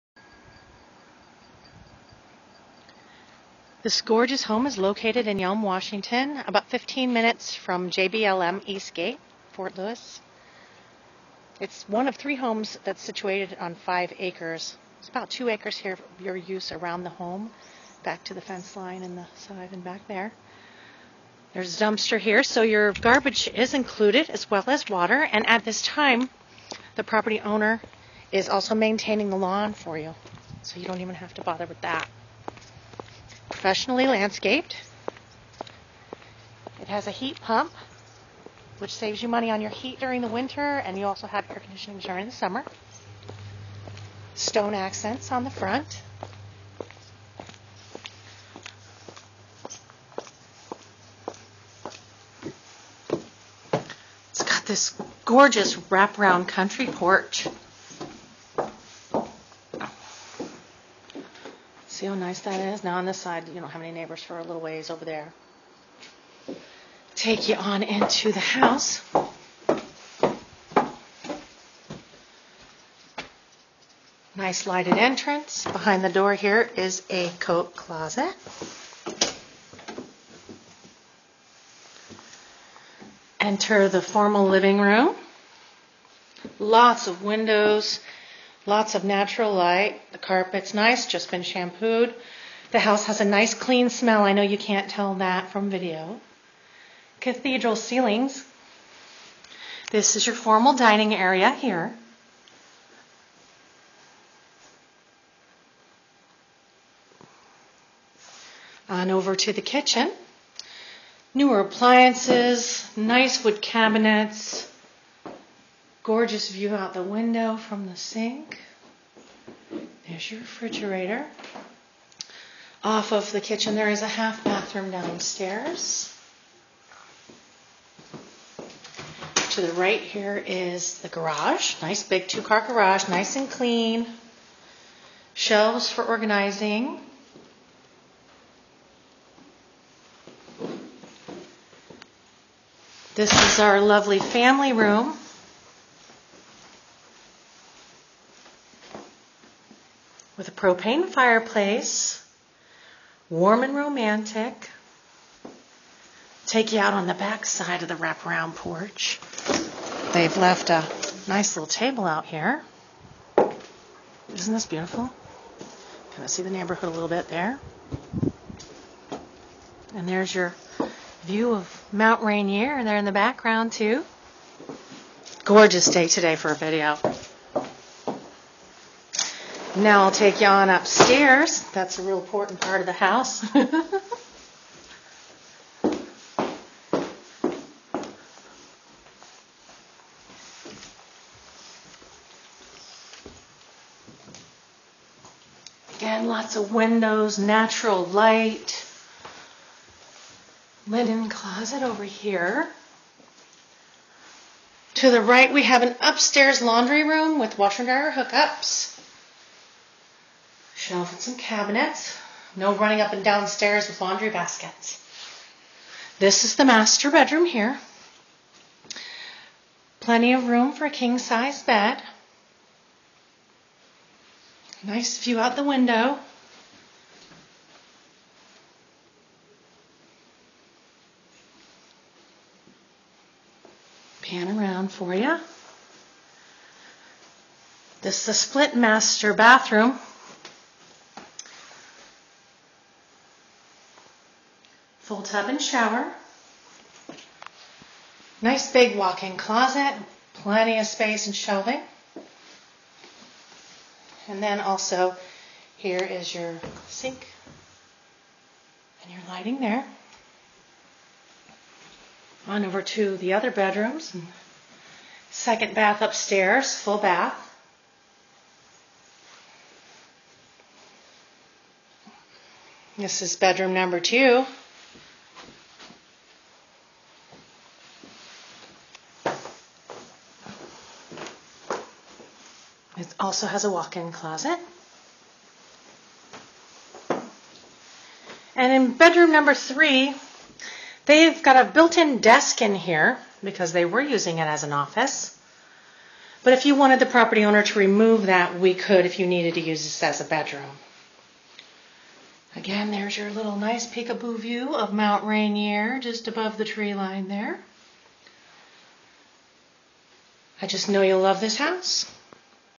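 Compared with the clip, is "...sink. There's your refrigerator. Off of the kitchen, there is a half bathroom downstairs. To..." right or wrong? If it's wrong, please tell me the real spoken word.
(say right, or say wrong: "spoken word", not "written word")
right.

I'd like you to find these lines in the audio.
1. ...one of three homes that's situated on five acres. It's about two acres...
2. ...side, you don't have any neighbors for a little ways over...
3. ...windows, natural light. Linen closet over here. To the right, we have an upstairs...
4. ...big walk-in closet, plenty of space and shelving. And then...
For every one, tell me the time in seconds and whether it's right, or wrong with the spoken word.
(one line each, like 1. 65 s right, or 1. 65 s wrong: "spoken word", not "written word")
1. 11 s right
2. 63 s right
3. 196 s right
4. 248 s right.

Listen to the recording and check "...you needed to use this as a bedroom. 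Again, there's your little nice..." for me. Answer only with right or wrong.
right.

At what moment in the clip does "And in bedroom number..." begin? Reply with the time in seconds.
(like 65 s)
288 s.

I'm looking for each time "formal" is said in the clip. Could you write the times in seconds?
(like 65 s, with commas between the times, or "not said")
84 s, 100 s.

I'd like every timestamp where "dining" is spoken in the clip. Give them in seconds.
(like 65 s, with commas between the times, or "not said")
100 s.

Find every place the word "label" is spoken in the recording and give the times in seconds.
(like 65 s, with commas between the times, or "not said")
not said.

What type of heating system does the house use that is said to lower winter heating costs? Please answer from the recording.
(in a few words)
Heat pump.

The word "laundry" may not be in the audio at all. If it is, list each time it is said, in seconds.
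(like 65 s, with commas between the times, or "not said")
206 s, 214 s.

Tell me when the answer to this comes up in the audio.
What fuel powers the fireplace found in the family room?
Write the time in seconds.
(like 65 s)
150 s.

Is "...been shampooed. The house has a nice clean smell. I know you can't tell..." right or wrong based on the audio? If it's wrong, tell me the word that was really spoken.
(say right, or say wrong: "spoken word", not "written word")
right.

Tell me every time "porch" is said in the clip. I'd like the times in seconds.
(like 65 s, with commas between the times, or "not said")
56 s, 158 s.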